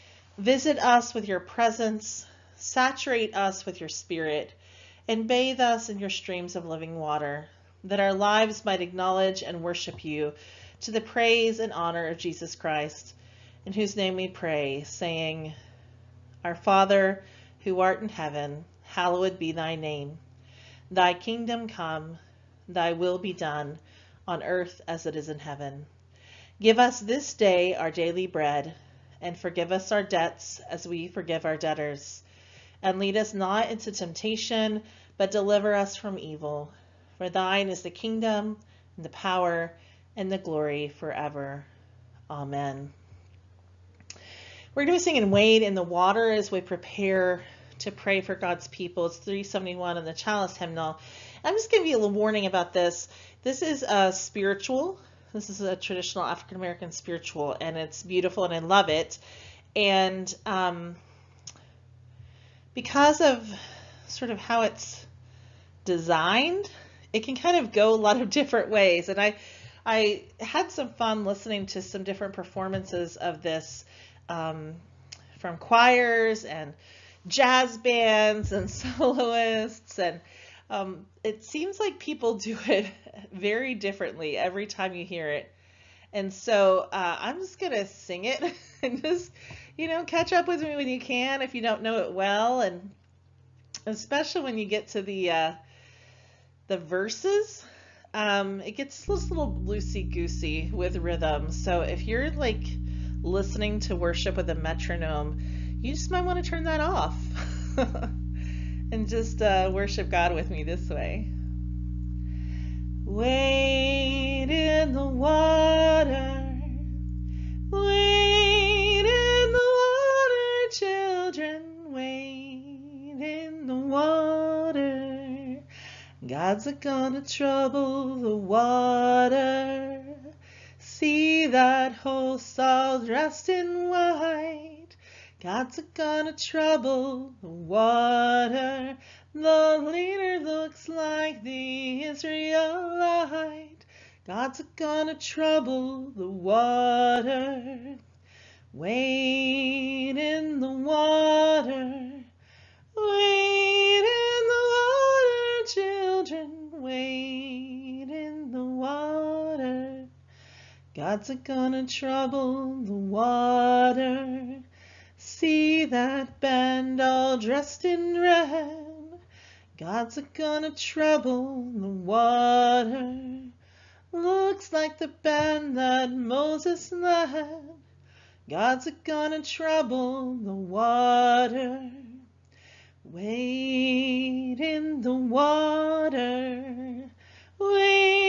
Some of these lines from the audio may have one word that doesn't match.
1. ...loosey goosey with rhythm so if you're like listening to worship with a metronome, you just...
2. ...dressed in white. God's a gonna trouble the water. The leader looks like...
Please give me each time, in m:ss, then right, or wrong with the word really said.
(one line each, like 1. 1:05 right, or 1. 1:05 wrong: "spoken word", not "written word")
1. 1:39 right
2. 2:12 right.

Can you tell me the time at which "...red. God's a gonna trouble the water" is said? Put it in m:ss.
2:48.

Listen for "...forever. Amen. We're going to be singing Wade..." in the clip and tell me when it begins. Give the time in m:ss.
0:40.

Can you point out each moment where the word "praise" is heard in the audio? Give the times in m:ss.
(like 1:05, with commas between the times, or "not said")
0:11.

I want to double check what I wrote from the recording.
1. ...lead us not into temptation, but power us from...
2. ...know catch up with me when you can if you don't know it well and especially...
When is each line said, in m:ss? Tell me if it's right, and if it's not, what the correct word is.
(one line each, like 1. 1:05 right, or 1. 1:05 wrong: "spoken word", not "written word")
1. 0:32 wrong: "deliver", not "power"
2. 1:29 right.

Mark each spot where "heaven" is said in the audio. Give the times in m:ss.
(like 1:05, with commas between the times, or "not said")
0:18, 0:25.